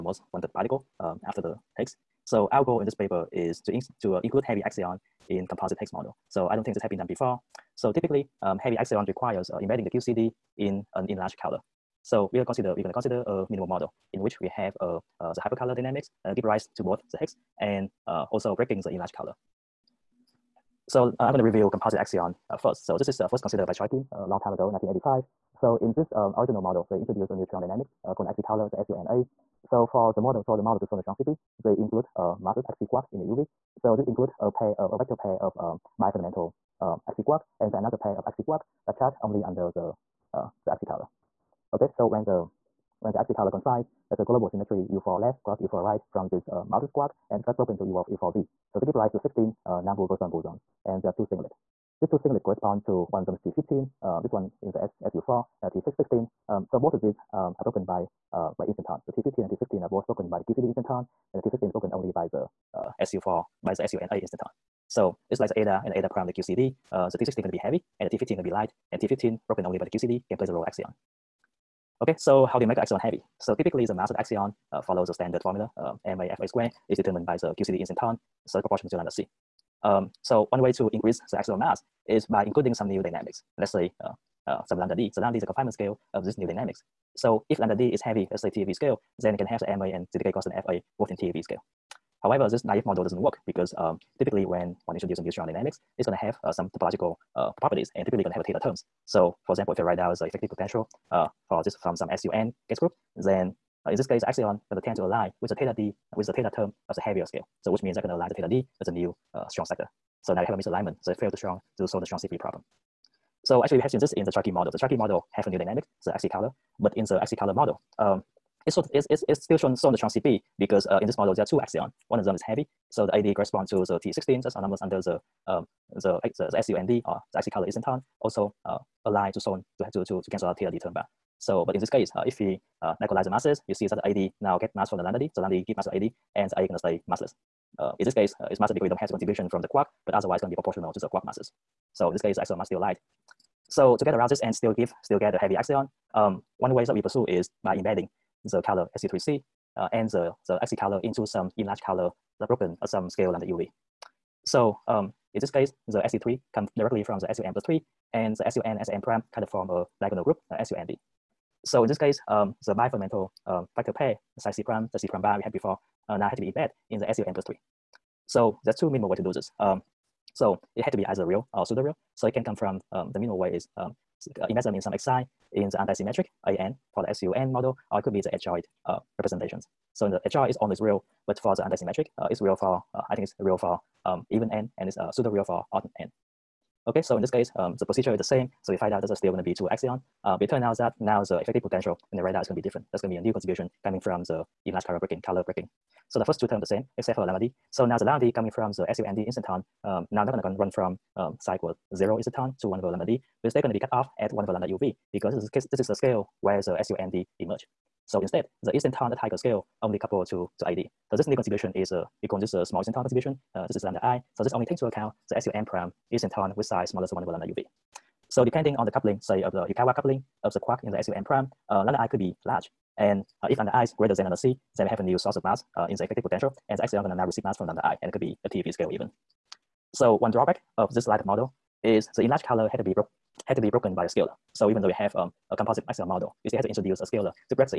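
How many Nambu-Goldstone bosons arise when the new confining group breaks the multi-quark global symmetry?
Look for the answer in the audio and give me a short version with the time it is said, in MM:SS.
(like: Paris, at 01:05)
16, at 00:49.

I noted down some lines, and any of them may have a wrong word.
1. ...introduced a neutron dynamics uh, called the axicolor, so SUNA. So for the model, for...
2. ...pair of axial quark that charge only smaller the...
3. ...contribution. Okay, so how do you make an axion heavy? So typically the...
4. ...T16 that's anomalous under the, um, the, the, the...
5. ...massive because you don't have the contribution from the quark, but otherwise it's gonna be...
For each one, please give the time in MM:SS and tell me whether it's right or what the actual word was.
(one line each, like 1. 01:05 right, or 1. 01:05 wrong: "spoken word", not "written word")
1. 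00:26 right
2. 00:37 wrong: "under", not "smaller"
3. 01:10 wrong: "axion", not "contribution"
4. 02:03 right
5. 02:18 right.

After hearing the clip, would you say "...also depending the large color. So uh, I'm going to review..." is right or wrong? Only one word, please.
wrong.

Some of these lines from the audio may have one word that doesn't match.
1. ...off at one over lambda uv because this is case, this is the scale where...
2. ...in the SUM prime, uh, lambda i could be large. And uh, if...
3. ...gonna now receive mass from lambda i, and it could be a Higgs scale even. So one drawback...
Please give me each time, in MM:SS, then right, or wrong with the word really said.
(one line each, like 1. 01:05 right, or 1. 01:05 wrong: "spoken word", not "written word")
1. 03:23 right
2. 03:40 right
3. 03:47 wrong: "TeV", not "Higgs".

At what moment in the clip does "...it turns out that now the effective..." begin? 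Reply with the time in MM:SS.
03:10.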